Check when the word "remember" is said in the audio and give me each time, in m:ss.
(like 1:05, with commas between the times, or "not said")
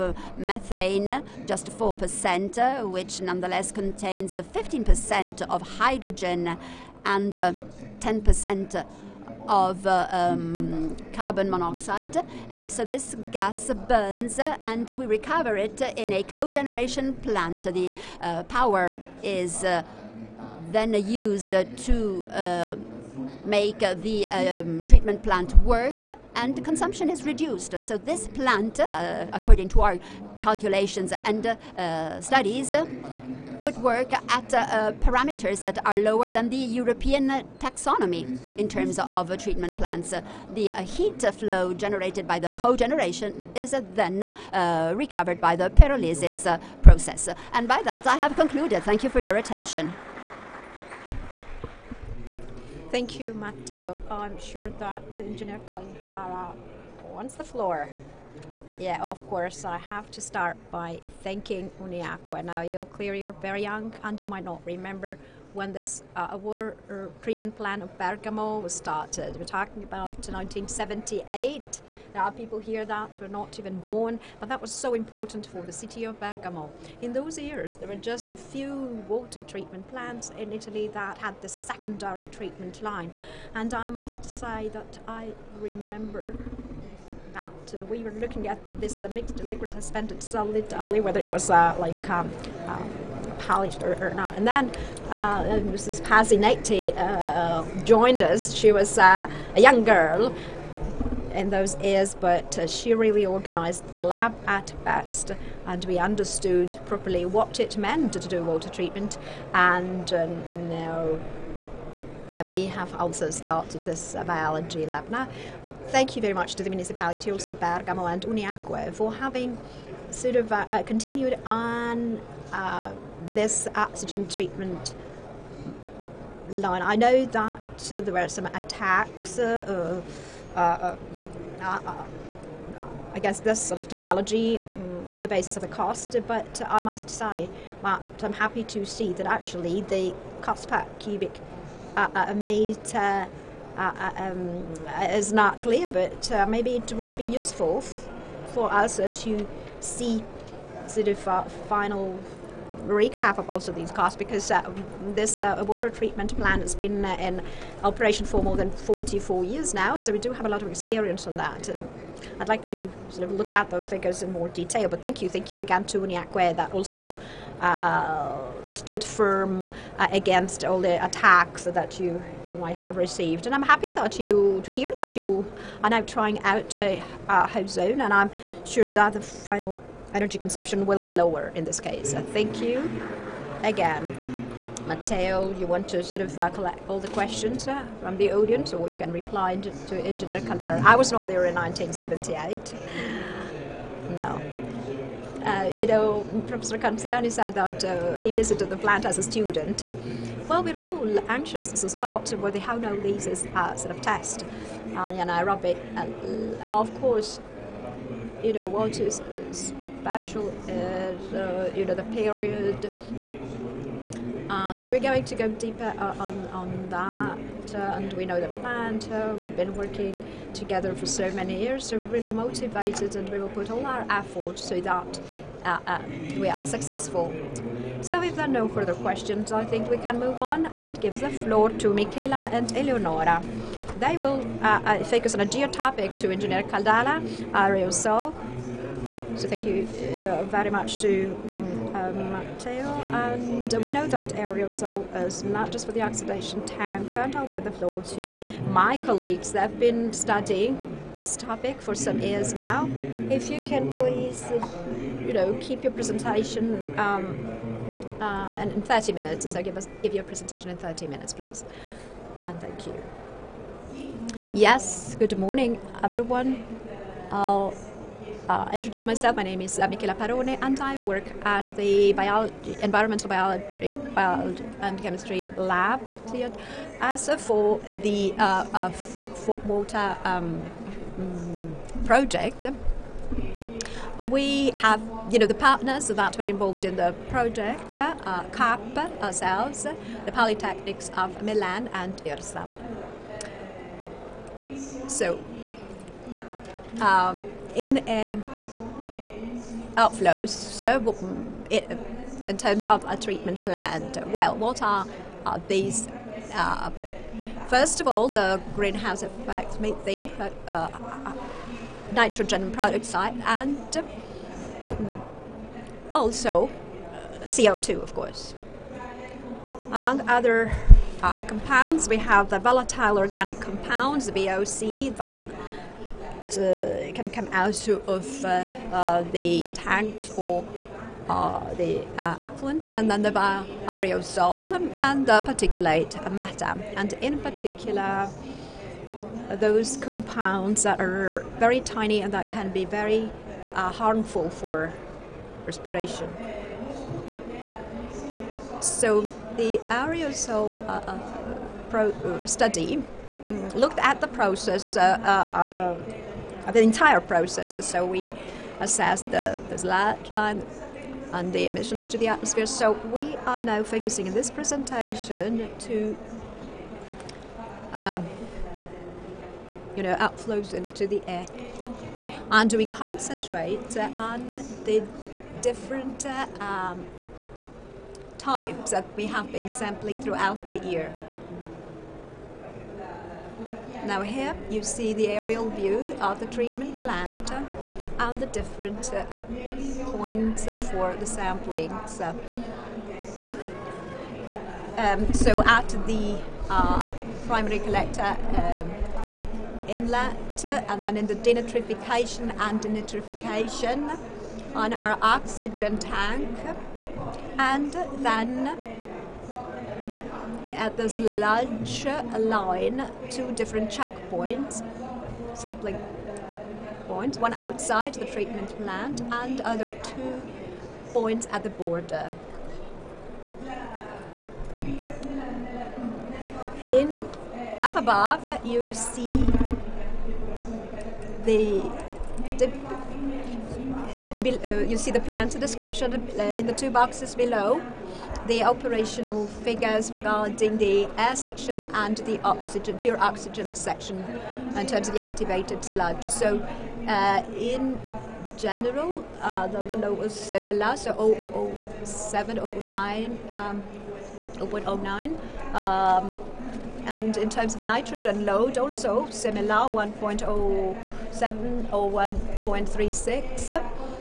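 1:04, 1:25.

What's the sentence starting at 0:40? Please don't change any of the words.
Uh, the uh, heat flow generated by the cogeneration is then uh, recovered by the pyrolysis process.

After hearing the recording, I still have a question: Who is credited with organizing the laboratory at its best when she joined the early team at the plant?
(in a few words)
Mrs. Pazzi Nati.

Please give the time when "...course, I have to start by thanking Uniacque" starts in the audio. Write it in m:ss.
0:59.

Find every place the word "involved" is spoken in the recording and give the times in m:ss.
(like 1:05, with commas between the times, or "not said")
4:46.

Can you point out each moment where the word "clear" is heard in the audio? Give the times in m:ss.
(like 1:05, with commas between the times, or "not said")
1:02, 2:25.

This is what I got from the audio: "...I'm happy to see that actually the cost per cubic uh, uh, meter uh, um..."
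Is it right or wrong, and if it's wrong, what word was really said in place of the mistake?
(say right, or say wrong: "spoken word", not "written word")
right.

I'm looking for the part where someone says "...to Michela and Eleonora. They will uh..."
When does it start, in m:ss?
3:51.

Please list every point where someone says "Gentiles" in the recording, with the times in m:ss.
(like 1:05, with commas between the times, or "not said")
not said.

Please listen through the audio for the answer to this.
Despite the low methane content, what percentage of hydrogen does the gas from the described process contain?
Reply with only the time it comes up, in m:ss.
0:04.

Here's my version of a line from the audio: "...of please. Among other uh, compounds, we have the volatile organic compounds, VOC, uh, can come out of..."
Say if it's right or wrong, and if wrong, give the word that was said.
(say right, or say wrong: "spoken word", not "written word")
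wrong: "course", not "please".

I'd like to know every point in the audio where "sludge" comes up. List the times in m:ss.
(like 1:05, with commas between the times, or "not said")
5:59, 6:51, 7:25.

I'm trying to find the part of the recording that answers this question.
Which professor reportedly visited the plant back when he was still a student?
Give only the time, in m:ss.
3:16.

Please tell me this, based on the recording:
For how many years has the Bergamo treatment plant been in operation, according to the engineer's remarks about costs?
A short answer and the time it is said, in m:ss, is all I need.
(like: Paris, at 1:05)
44 years, at 2:38.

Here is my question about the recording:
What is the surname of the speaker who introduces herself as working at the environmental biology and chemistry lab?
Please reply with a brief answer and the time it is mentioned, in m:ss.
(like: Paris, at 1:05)
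Parone, at 4:29.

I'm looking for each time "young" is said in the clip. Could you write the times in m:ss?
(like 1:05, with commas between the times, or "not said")
1:03, 1:39.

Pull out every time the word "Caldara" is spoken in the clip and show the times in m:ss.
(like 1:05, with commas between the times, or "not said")
0:55, 3:10, 3:56.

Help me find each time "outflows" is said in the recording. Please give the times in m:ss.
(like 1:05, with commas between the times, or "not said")
4:59, 6:10.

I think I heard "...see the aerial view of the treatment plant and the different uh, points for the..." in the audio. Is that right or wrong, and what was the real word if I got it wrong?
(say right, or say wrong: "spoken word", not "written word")
right.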